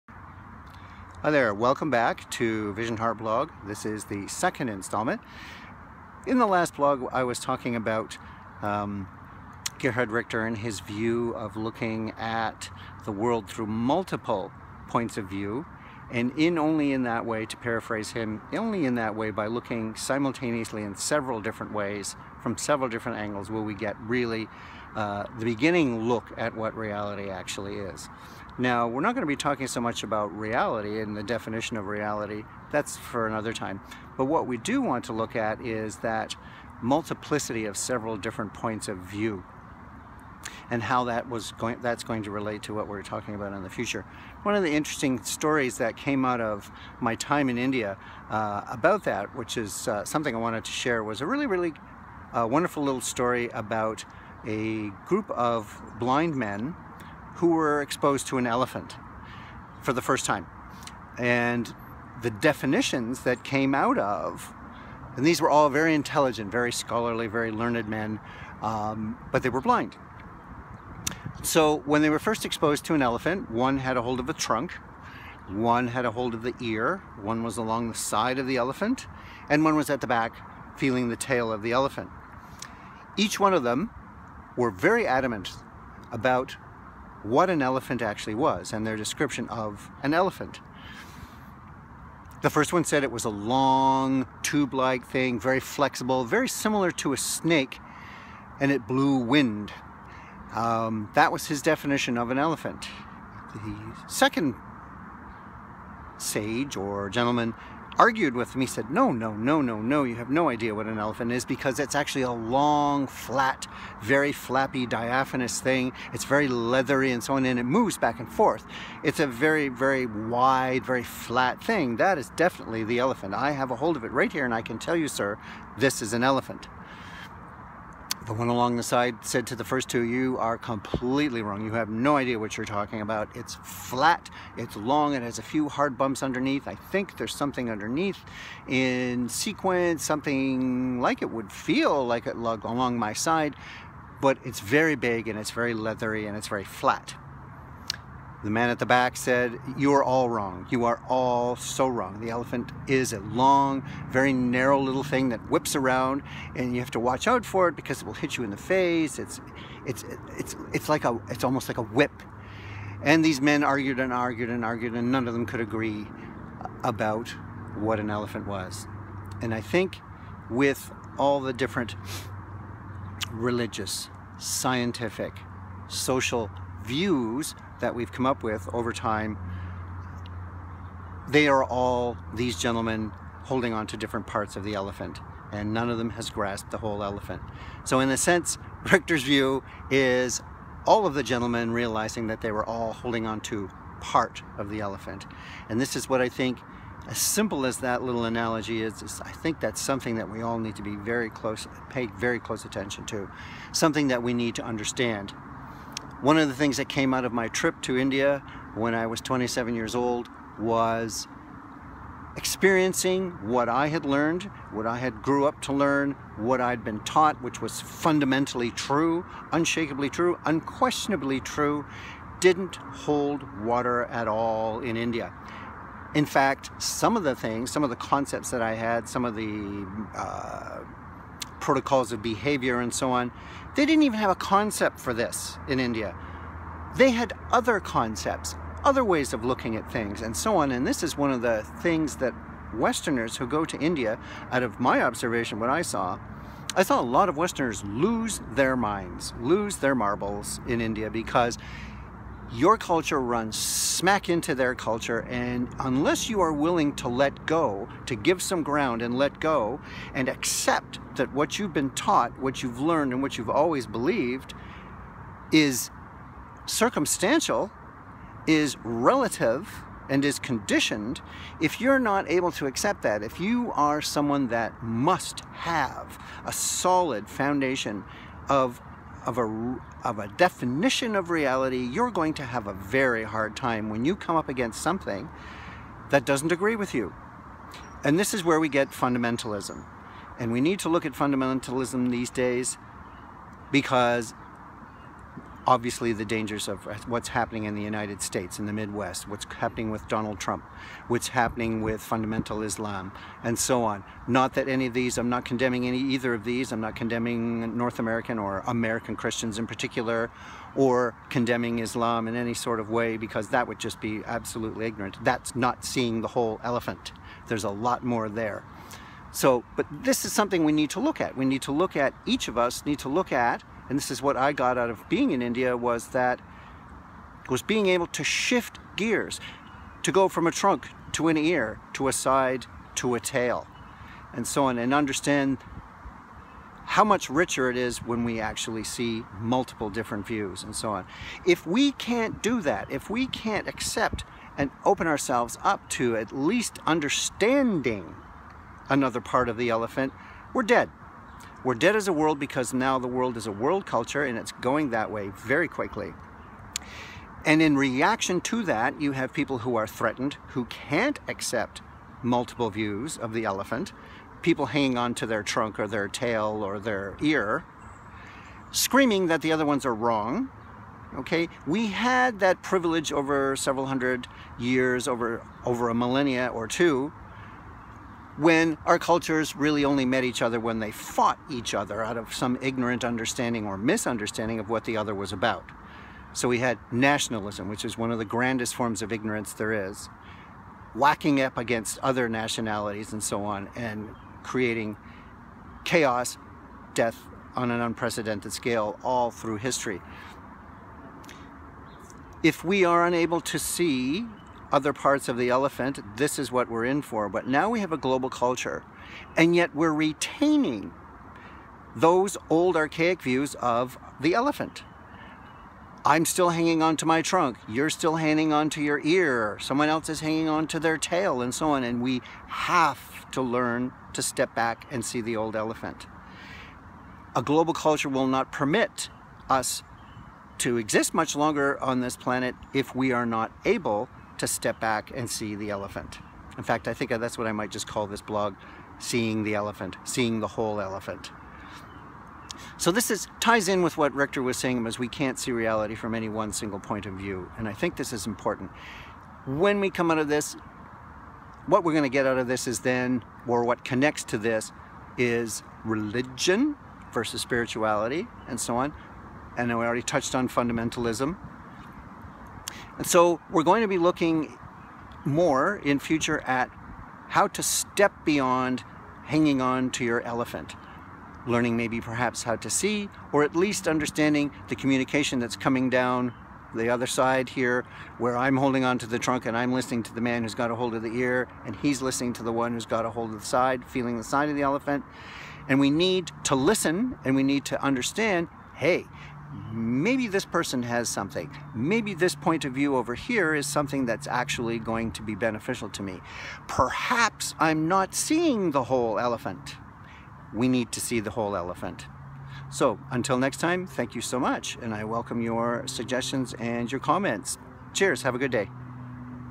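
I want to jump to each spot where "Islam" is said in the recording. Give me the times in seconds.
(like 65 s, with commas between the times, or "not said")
302 s, 311 s.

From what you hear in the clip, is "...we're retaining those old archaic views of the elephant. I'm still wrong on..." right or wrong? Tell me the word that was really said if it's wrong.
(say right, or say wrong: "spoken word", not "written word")
wrong: "hanging", not "wrong".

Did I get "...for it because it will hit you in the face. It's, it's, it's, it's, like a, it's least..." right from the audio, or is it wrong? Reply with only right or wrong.
wrong.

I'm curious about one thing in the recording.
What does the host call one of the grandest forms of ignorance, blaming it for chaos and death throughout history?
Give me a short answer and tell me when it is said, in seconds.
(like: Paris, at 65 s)
Nationalism, at 386 s.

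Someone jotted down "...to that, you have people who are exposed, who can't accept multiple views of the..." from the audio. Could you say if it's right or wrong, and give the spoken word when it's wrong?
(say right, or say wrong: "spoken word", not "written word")
wrong: "threatened", not "exposed".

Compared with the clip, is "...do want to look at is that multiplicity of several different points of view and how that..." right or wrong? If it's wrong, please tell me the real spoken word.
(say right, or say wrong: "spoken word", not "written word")
right.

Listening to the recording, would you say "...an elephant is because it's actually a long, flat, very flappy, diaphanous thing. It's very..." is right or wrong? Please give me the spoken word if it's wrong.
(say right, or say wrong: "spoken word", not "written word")
right.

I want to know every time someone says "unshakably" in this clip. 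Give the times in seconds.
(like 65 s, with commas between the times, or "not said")
219 s.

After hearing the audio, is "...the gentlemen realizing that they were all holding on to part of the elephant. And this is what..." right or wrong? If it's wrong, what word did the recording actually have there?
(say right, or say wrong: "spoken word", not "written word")
right.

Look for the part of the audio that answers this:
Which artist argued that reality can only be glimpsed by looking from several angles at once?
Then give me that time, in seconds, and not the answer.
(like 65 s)
9 s.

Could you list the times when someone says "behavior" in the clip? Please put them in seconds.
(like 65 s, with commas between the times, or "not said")
232 s.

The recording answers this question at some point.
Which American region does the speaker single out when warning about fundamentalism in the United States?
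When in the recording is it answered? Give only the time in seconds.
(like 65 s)
298 s.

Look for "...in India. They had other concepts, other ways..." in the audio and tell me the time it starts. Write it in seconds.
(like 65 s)
235 s.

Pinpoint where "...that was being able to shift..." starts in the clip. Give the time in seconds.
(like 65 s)
326 s.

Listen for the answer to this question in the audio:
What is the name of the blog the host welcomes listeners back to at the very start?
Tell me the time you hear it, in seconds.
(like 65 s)
2 s.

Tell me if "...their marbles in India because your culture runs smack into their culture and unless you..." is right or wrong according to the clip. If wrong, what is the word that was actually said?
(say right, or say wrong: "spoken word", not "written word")
right.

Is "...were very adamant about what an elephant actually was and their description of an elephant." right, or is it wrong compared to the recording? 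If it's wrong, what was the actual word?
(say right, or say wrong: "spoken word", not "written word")
right.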